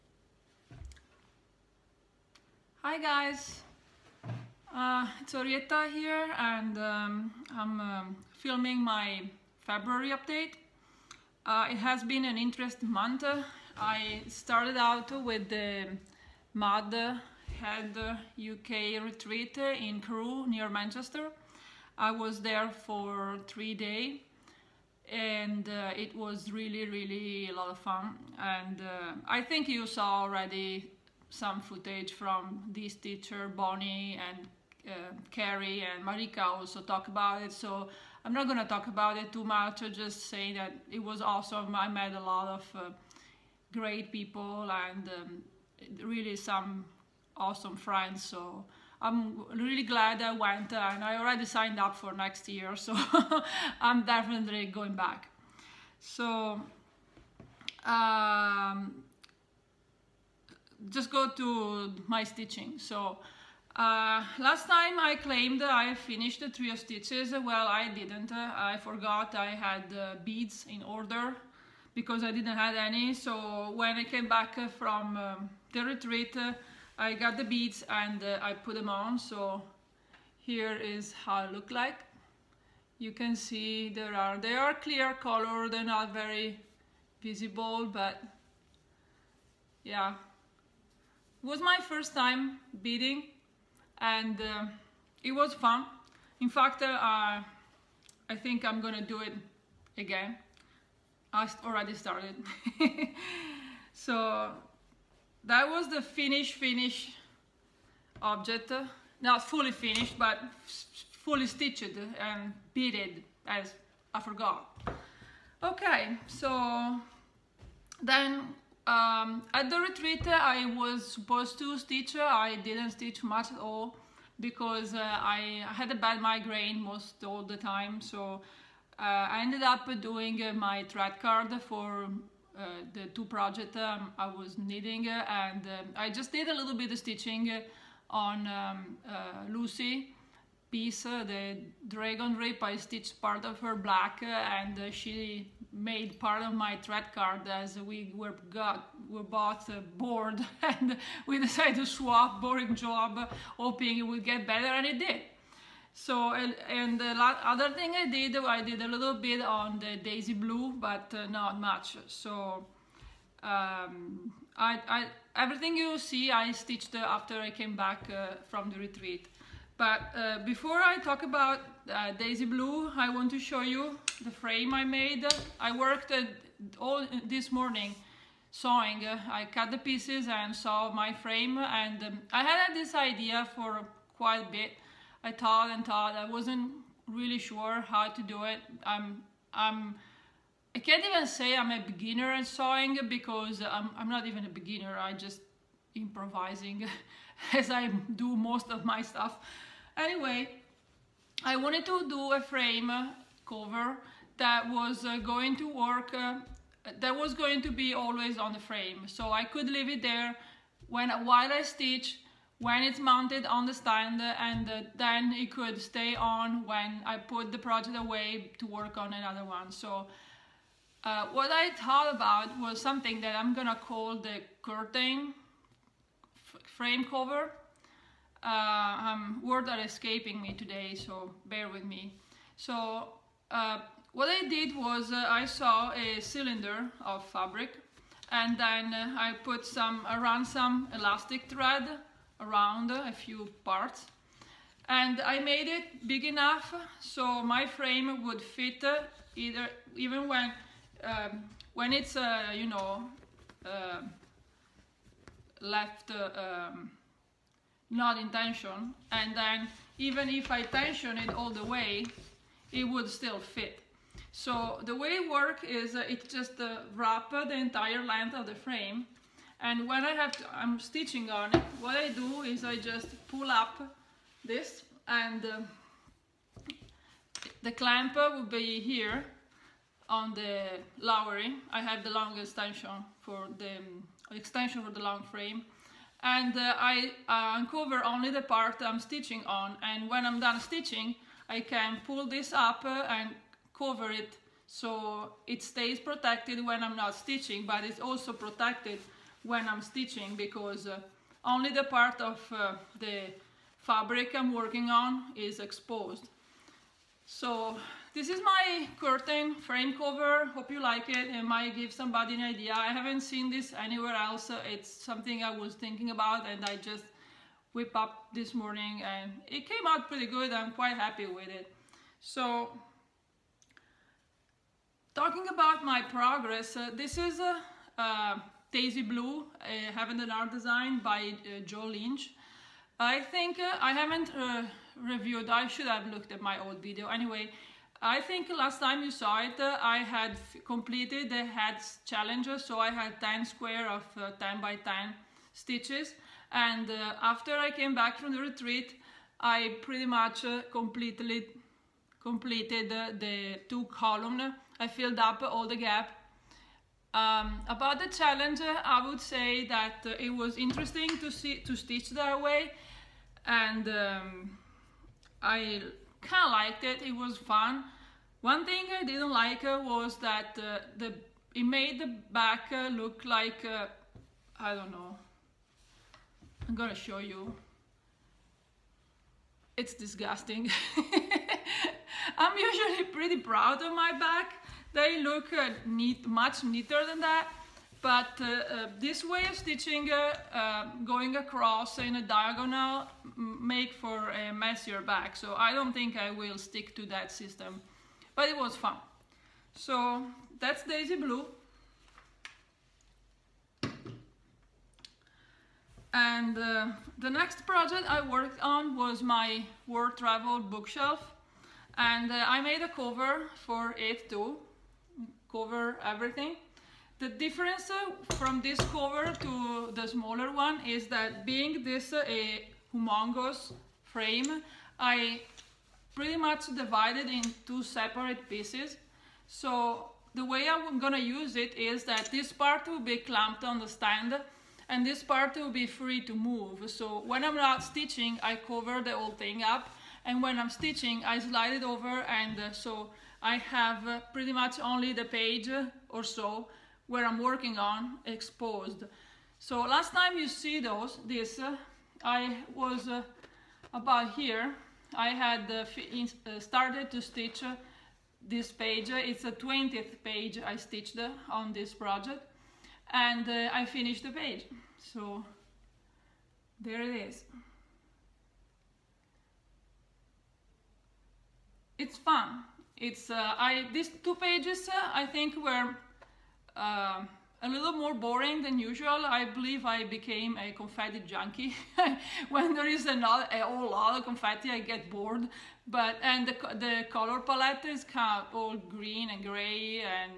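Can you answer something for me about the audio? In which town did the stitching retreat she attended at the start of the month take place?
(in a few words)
Crewe.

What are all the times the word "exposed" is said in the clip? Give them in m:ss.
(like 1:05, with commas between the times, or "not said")
5:05, 7:28.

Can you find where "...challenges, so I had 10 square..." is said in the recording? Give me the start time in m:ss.
5:42.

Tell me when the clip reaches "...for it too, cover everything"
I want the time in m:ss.
6:53.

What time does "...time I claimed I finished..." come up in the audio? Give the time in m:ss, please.
1:04.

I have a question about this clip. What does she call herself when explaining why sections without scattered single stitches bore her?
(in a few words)
Confetti junkie.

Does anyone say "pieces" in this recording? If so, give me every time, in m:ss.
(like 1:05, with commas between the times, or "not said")
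2:20, 2:59, 7:08.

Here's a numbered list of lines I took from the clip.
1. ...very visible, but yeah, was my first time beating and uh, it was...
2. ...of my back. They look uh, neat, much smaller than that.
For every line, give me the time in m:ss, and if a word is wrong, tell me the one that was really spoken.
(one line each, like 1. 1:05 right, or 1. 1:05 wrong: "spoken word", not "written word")
1. 1:26 right
2. 6:23 wrong: "neater", not "smaller".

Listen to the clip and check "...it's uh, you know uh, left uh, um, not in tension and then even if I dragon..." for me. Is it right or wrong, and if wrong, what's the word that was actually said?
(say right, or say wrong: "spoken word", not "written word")
wrong: "tension", not "dragon".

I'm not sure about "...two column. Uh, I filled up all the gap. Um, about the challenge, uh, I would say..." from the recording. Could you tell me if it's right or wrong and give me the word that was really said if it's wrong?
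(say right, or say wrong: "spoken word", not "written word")
right.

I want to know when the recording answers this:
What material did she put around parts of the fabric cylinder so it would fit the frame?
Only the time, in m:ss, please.
4:00.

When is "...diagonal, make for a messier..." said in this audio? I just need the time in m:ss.
6:32.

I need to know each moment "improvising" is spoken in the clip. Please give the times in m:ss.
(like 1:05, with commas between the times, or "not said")
3:15.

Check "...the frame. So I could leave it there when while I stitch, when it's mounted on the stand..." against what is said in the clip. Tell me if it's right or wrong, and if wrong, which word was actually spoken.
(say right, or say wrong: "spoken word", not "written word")
right.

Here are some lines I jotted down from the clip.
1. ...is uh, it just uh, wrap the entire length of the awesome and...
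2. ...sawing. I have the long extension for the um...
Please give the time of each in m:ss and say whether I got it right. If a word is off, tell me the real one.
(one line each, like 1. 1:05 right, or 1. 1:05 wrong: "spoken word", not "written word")
1. 4:25 wrong: "frame", not "awesome"
2. 4:40 wrong: "lowering", not "sawing".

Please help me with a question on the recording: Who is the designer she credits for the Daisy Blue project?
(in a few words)
Joe Lynch.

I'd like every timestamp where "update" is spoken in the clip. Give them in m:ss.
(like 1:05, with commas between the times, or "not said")
0:10.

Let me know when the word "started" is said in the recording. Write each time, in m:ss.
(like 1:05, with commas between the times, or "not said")
0:14, 1:41, 7:36.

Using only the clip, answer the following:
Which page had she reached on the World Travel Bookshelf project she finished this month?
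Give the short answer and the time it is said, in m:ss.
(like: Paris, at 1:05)
20th, at 7:39.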